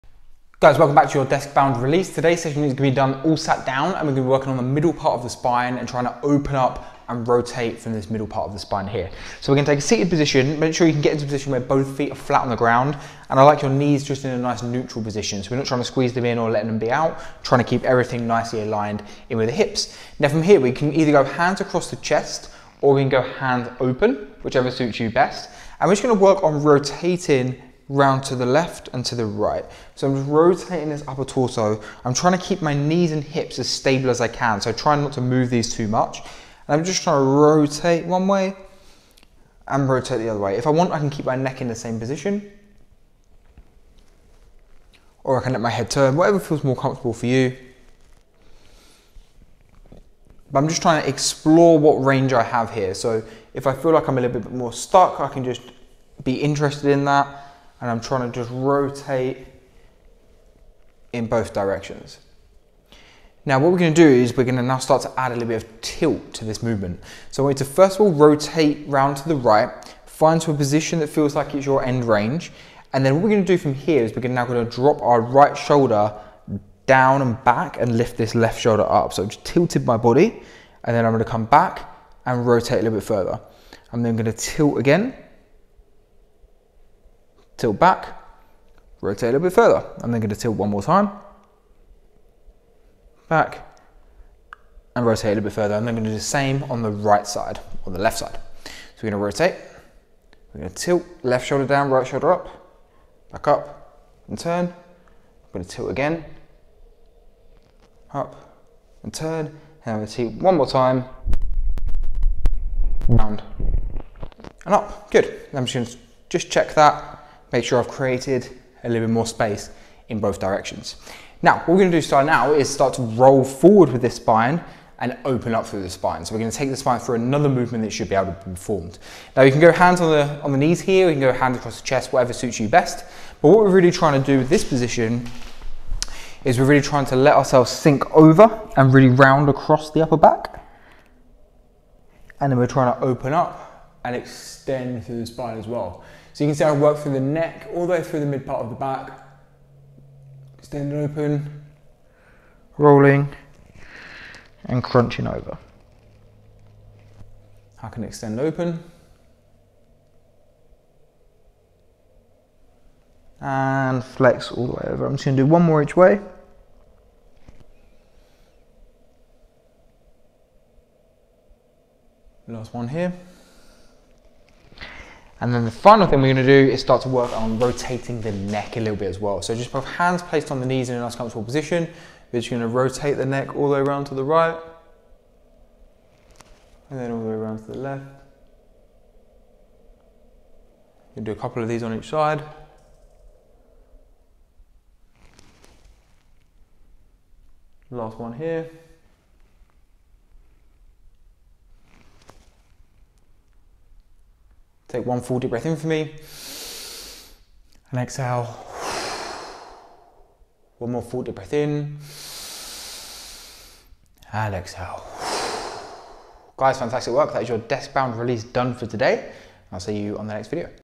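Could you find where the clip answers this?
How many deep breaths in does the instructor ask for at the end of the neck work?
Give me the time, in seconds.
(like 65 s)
210 s.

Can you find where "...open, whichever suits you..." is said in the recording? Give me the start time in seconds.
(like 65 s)
23 s.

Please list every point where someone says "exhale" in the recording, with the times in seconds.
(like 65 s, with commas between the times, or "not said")
208 s, 214 s.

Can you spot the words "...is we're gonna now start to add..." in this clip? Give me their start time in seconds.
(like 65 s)
64 s.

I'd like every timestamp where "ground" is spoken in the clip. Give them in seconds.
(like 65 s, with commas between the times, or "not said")
12 s.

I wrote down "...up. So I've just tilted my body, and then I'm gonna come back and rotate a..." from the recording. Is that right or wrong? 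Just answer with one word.
right.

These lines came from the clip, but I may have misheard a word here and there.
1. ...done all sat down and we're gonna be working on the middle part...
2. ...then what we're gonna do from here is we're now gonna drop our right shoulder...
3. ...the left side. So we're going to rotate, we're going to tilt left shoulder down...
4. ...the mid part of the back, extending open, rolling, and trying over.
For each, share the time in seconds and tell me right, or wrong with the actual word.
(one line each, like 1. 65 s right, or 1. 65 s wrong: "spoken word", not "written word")
1. 2 s right
2. 73 s right
3. 97 s right
4. 148 s wrong: "crunching", not "trying".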